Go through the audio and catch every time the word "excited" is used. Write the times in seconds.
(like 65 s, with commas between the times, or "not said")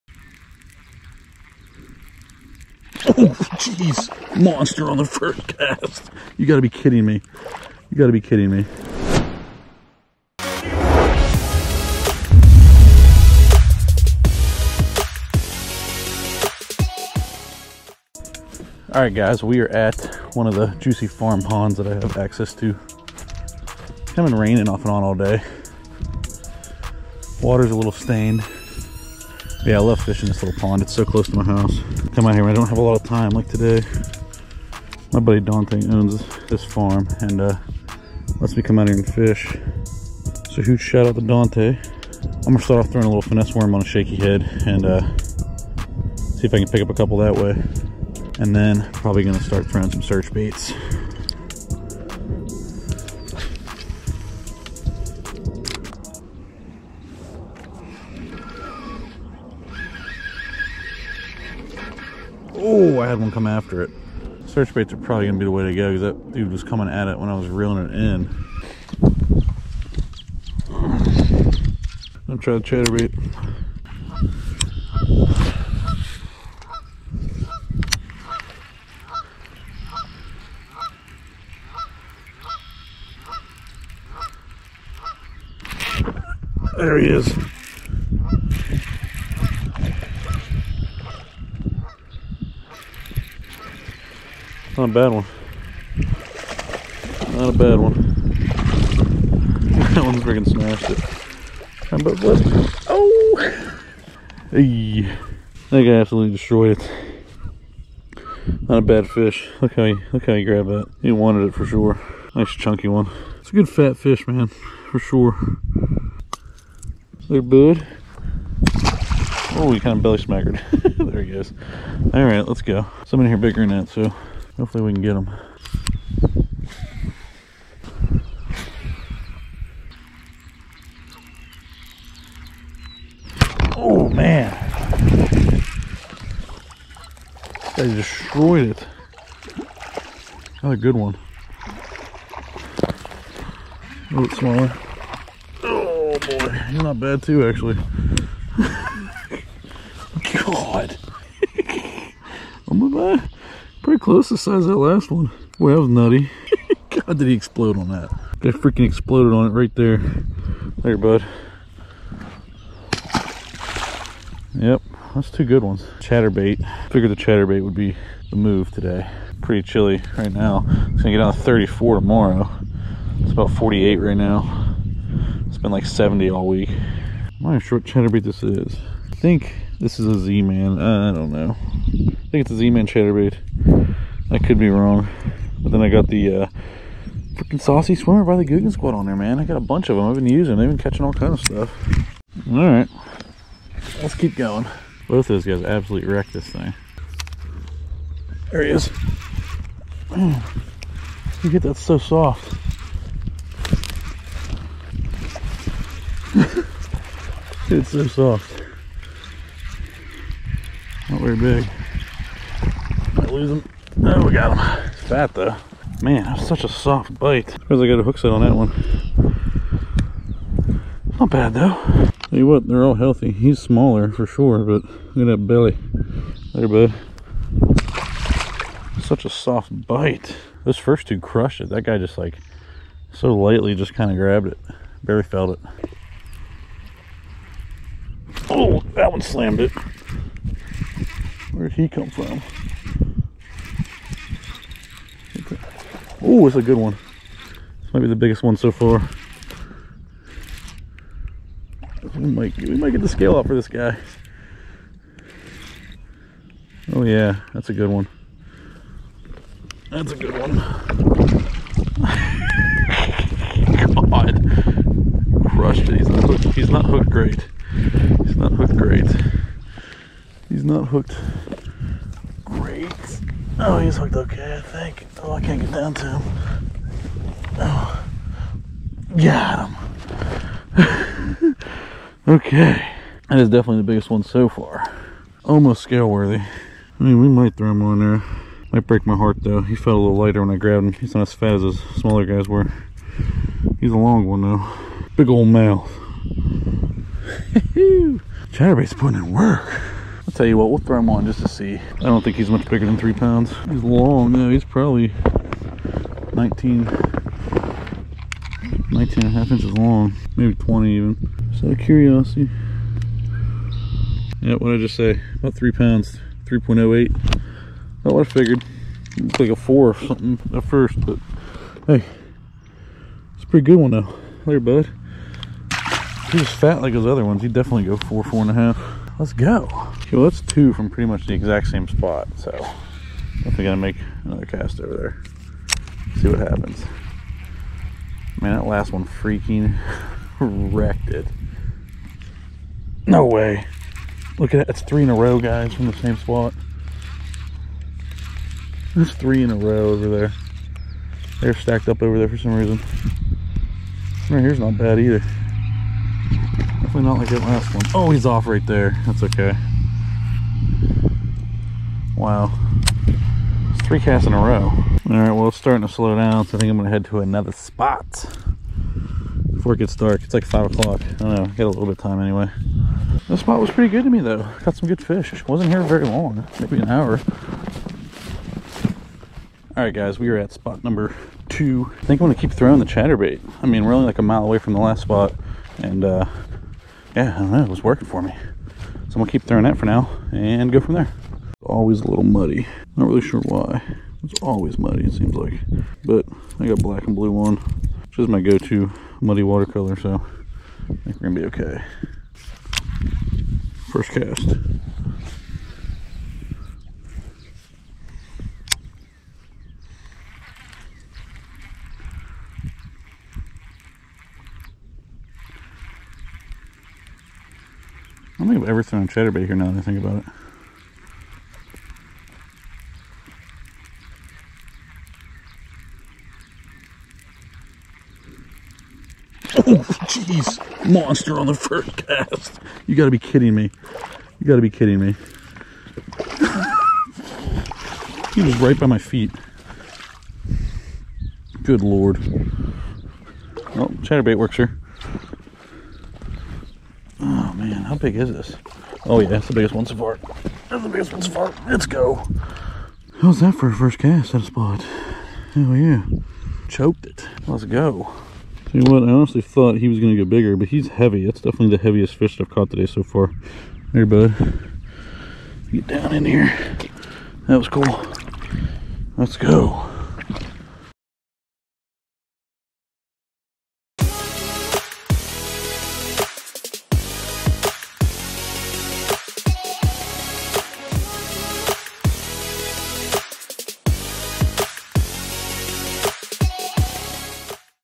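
not said.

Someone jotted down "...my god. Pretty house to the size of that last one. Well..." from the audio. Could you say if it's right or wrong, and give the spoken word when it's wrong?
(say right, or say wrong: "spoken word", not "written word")
wrong: "close", not "house".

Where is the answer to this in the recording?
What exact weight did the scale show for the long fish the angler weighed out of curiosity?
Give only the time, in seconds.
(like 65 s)
316 s.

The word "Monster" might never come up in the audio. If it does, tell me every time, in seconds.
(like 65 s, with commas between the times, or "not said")
4 s, 430 s.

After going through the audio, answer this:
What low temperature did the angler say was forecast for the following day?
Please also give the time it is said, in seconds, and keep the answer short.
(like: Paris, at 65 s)
34, at 171 s.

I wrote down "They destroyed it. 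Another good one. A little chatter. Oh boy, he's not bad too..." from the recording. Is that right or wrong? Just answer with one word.
wrong.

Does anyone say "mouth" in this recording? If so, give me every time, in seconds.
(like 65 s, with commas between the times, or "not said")
295 s.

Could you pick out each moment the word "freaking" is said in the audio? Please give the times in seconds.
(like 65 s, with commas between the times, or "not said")
100 s, 158 s, 187 s, 339 s.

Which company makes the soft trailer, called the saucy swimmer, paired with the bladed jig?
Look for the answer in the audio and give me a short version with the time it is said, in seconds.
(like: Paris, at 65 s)
Googan Squad, at 188 s.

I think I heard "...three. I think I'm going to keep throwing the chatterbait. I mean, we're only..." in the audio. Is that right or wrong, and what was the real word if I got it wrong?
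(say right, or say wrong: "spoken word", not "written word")
wrong: "two", not "three".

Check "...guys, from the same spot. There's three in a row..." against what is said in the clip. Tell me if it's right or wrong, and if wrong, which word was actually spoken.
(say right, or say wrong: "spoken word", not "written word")
right.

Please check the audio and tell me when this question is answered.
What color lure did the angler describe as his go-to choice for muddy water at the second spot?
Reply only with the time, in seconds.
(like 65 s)
396 s.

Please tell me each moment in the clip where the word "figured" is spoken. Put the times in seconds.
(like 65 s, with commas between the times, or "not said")
166 s, 318 s.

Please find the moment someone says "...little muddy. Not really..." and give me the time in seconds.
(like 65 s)
392 s.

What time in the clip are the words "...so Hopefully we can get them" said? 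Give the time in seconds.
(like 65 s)
123 s.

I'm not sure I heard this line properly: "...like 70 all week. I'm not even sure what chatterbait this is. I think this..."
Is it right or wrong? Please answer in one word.
right.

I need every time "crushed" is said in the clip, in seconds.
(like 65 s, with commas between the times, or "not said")
231 s, 265 s.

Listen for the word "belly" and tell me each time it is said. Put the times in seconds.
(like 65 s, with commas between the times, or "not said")
120 s, 225 s.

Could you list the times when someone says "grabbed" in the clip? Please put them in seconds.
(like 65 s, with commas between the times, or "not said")
110 s, 234 s, 290 s.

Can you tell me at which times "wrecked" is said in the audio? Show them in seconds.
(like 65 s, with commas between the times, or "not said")
196 s, 340 s.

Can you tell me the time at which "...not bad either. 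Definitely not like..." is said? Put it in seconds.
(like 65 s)
354 s.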